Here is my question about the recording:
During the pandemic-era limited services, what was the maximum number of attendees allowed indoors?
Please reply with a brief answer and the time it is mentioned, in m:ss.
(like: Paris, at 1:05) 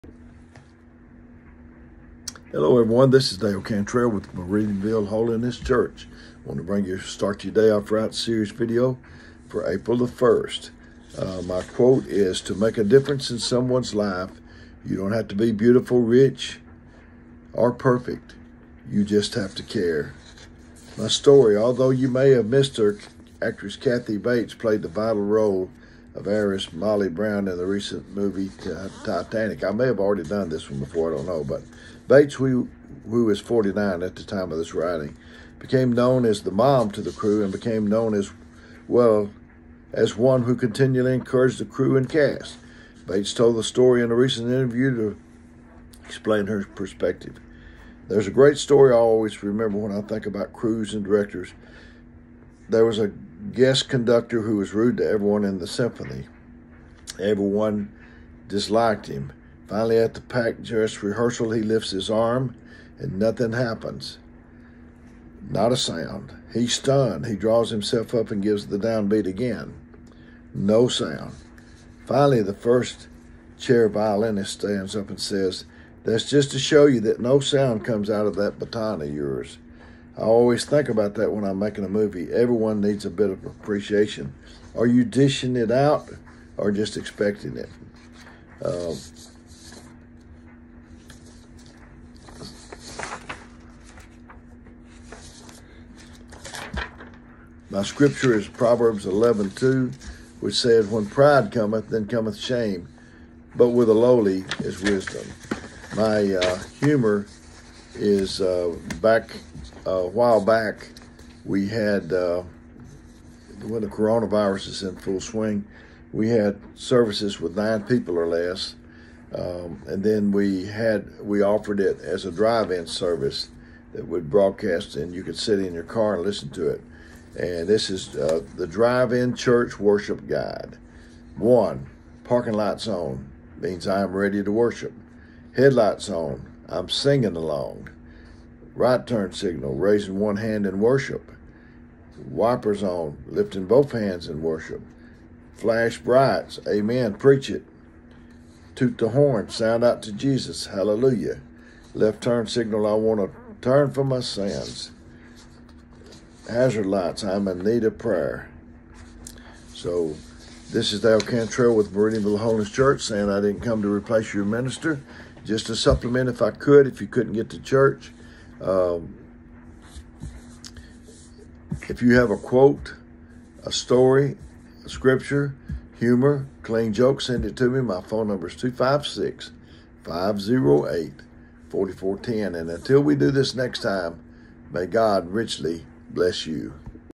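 9, at 1:57.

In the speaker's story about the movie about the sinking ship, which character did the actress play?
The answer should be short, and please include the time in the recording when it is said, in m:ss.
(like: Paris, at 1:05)
Molly Brown, at 0:26.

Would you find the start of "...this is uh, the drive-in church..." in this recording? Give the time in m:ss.
2:07.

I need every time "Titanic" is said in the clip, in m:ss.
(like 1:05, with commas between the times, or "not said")
0:29.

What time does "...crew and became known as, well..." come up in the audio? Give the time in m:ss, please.
0:37.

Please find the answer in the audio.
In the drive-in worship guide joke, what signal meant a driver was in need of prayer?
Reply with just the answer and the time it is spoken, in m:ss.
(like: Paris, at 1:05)
Hazard lights, at 2:36.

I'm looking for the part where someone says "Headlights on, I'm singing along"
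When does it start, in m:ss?
2:15.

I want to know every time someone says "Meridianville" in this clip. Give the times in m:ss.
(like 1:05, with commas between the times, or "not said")
0:04, 2:41.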